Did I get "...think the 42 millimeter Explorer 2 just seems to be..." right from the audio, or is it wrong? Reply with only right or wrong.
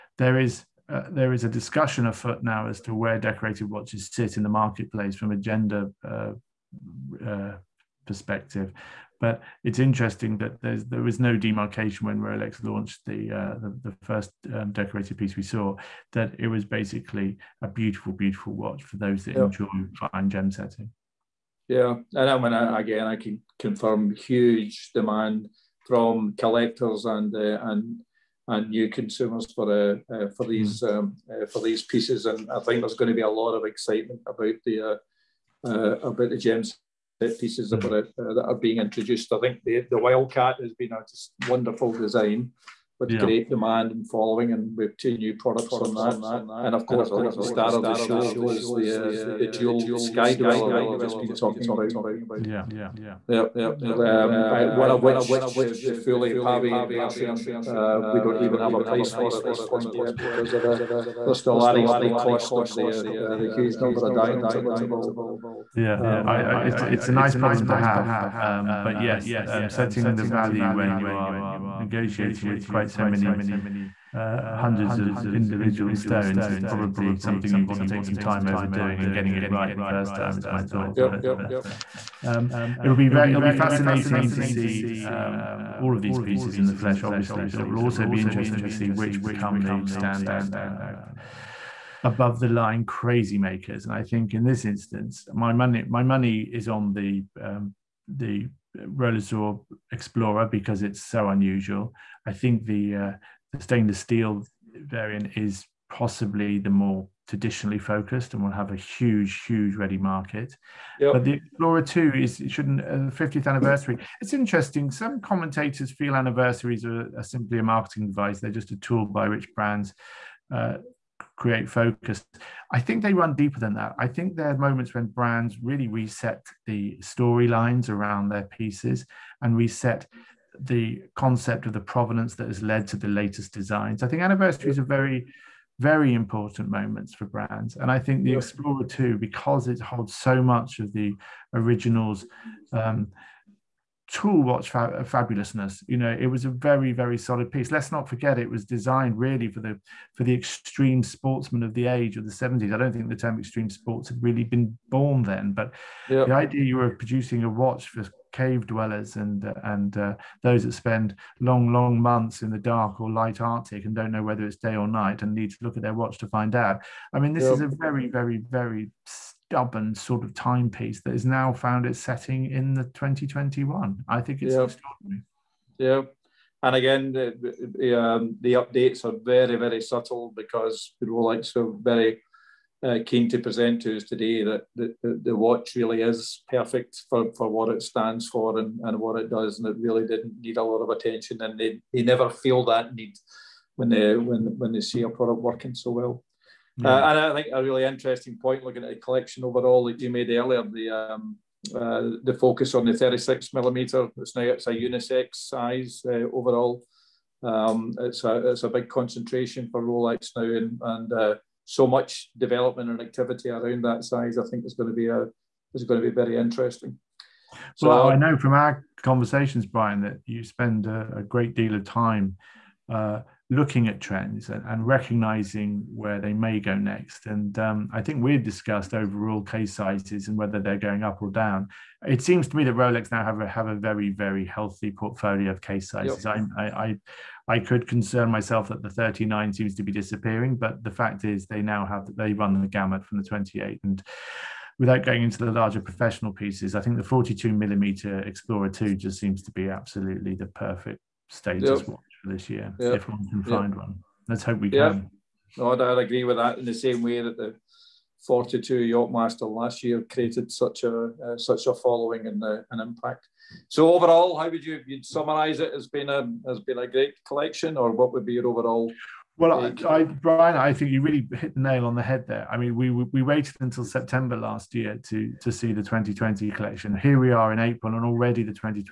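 right.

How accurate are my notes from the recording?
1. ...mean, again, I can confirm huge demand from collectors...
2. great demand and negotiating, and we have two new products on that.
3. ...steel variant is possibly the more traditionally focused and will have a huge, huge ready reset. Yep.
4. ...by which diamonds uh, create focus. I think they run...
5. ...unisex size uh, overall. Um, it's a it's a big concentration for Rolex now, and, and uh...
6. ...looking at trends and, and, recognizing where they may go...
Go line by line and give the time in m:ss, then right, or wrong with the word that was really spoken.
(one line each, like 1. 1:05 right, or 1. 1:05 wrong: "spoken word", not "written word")
1. 0:22 right
2. 0:43 wrong: "following", not "negotiating"
3. 1:43 wrong: "market", not "reset"
4. 1:59 wrong: "brands", not "diamonds"
5. 3:24 right
6. 3:43 right.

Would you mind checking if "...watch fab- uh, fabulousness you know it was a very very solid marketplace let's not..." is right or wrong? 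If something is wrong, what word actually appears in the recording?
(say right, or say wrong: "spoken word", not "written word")
wrong: "piece", not "marketplace".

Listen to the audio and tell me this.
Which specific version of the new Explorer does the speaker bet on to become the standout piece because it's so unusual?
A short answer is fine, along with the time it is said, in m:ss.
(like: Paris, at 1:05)
Rolesor Explorer, at 1:38.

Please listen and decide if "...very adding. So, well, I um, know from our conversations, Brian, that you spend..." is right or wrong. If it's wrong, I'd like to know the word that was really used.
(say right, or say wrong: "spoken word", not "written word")
wrong: "interesting", not "adding".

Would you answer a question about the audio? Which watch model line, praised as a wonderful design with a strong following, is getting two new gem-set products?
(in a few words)
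Wildcat.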